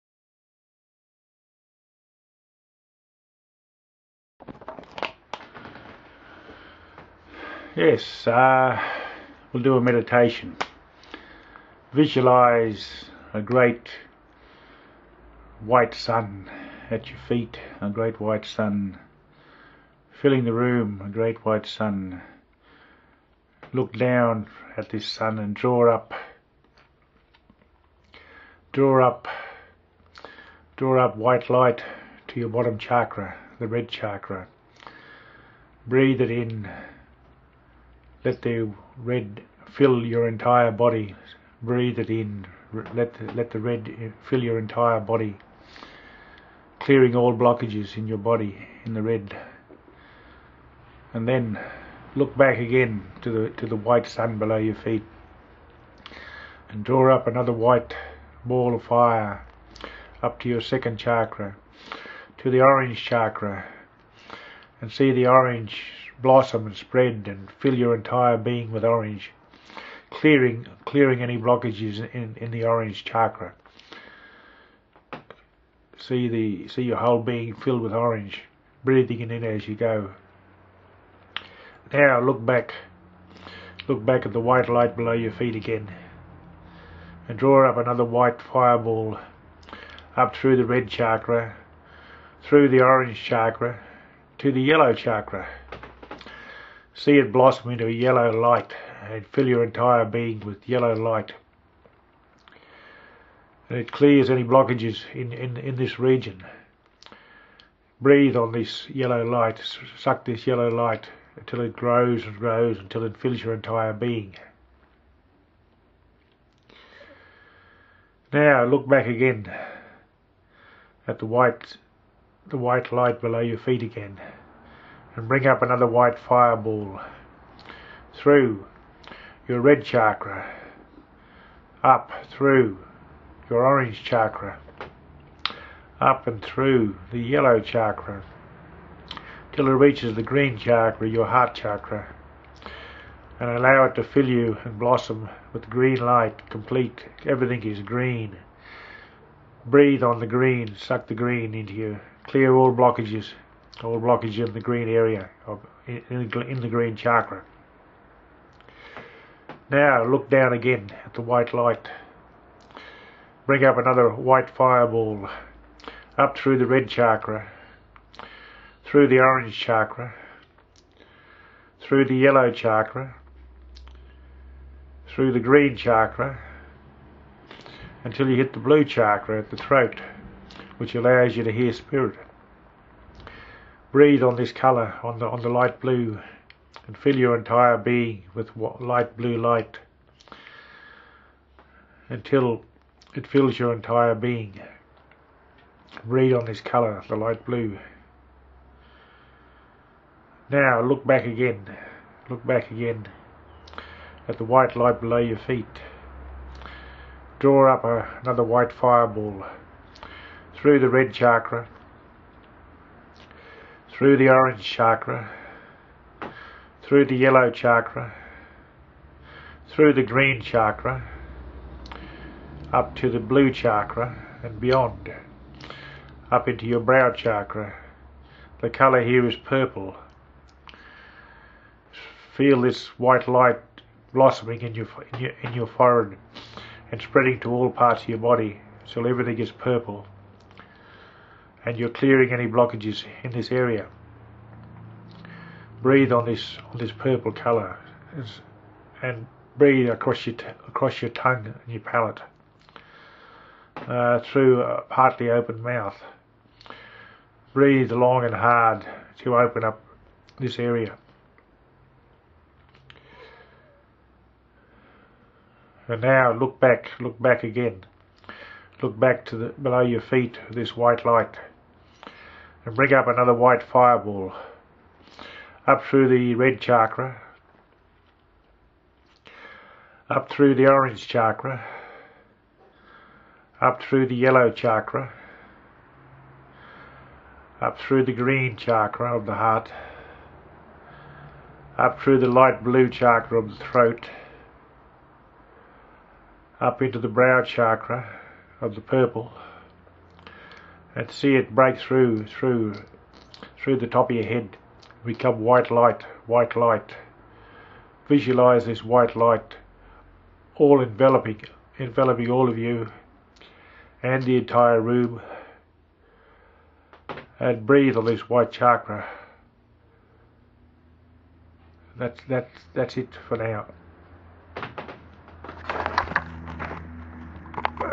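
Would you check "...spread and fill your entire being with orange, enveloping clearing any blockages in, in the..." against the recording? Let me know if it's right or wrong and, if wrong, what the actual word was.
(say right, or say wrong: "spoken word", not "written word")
wrong: "clearing", not "enveloping".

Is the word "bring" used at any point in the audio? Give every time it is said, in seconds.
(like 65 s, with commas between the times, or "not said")
125 s, 163 s, 272 s.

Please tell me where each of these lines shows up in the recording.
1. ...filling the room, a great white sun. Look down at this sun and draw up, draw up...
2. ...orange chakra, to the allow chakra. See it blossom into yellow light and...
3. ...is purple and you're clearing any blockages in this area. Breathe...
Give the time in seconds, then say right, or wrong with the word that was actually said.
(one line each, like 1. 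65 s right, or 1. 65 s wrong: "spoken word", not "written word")
1. 20 s right
2. 92 s wrong: "yellow", not "allow"
3. 239 s right.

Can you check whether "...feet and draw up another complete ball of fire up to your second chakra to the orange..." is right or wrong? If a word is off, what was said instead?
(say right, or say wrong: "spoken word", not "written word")
wrong: "white", not "complete".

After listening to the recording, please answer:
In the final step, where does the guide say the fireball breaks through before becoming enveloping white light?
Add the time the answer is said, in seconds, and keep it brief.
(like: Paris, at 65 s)
top of your head, at 303 s.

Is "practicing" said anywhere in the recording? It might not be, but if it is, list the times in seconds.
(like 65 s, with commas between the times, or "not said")
not said.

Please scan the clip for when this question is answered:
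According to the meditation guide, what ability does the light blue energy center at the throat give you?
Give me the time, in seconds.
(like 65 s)
181 s.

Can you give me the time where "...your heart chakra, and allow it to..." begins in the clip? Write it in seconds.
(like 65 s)
141 s.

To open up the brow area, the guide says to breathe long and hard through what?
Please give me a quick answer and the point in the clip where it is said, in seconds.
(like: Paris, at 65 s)
a partly open mouth, at 254 s.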